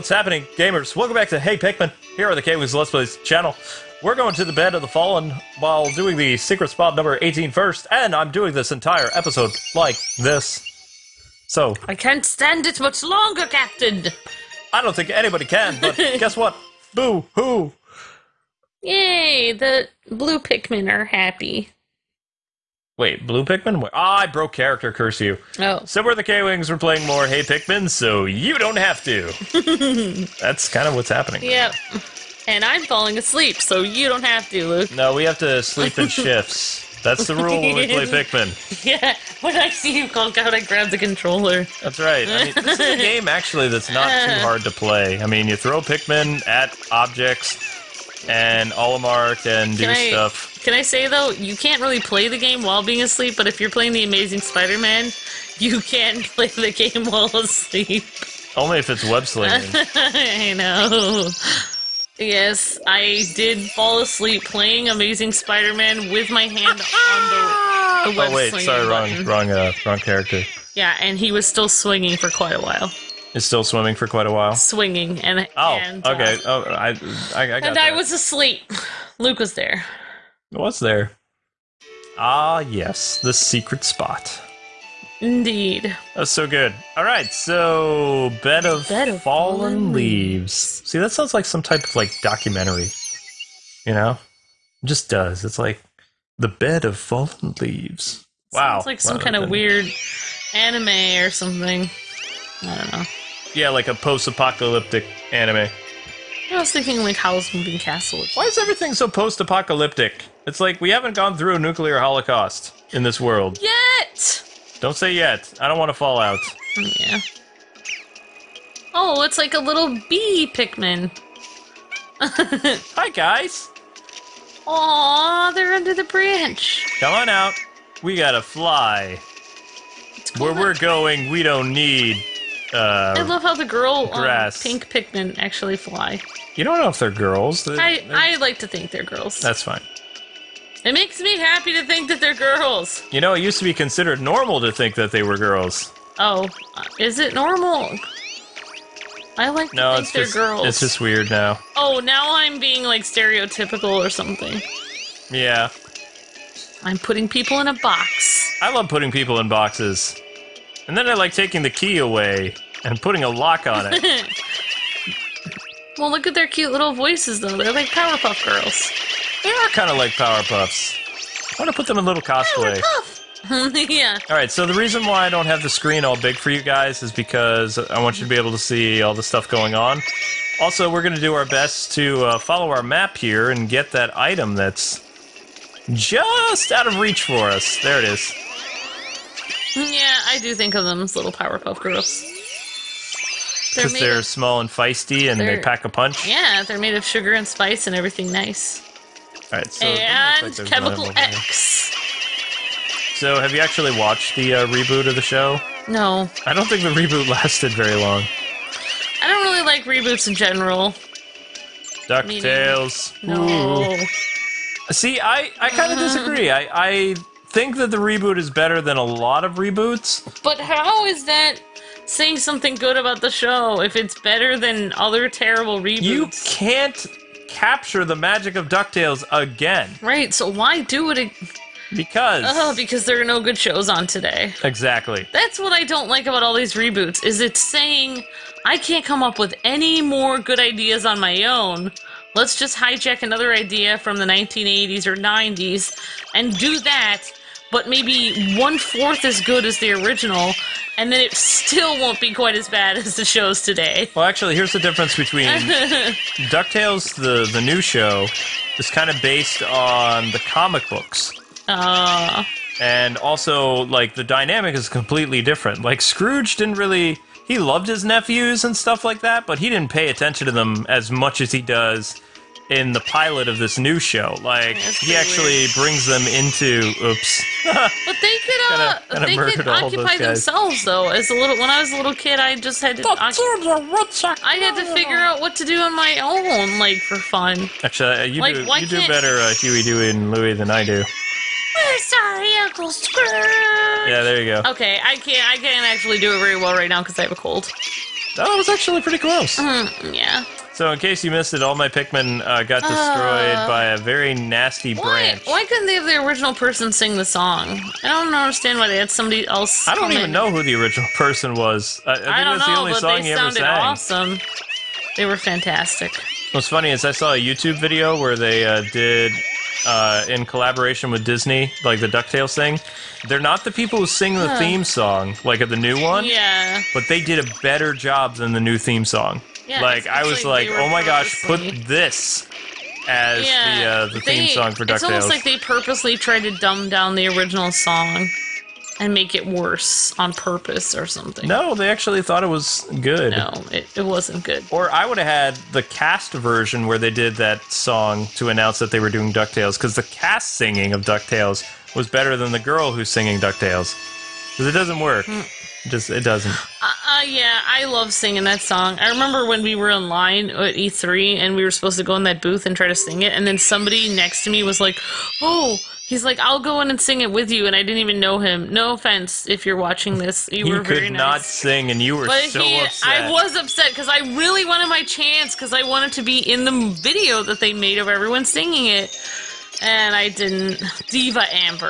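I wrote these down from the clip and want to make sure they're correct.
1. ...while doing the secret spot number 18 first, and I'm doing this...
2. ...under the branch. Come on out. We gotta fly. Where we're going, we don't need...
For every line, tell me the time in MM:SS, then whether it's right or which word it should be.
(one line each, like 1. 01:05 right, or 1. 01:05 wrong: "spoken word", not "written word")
1. 00:05 right
2. 02:05 right.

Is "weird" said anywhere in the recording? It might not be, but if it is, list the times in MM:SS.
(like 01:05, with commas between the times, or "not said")
01:39, 02:30, 04:35.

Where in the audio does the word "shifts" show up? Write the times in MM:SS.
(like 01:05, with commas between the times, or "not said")
00:36.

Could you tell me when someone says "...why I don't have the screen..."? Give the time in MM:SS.
02:55.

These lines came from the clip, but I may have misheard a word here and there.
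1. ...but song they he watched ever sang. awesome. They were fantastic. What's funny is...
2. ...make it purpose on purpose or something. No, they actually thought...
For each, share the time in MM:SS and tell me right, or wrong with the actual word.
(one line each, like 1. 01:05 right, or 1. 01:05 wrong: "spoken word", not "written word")
1. 05:12 wrong: "sounded", not "watched"
2. 05:39 wrong: "worse", not "purpose".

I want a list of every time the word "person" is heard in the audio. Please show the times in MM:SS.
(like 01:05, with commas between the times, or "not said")
05:06, 05:11.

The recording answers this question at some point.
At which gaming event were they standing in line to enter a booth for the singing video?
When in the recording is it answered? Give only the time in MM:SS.
06:00.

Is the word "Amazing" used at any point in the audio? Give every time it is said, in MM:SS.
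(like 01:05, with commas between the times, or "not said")
00:54, 01:04.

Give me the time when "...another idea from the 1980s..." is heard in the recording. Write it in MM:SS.
04:03.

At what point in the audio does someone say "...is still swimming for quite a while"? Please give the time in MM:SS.
01:13.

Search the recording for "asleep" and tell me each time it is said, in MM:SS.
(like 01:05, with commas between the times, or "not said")
00:33, 00:53, 00:57, 01:03, 01:18.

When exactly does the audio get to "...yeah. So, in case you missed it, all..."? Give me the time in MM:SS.
05:00.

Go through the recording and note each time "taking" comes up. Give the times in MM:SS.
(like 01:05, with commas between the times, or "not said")
02:41.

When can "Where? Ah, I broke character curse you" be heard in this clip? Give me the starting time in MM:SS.
00:23.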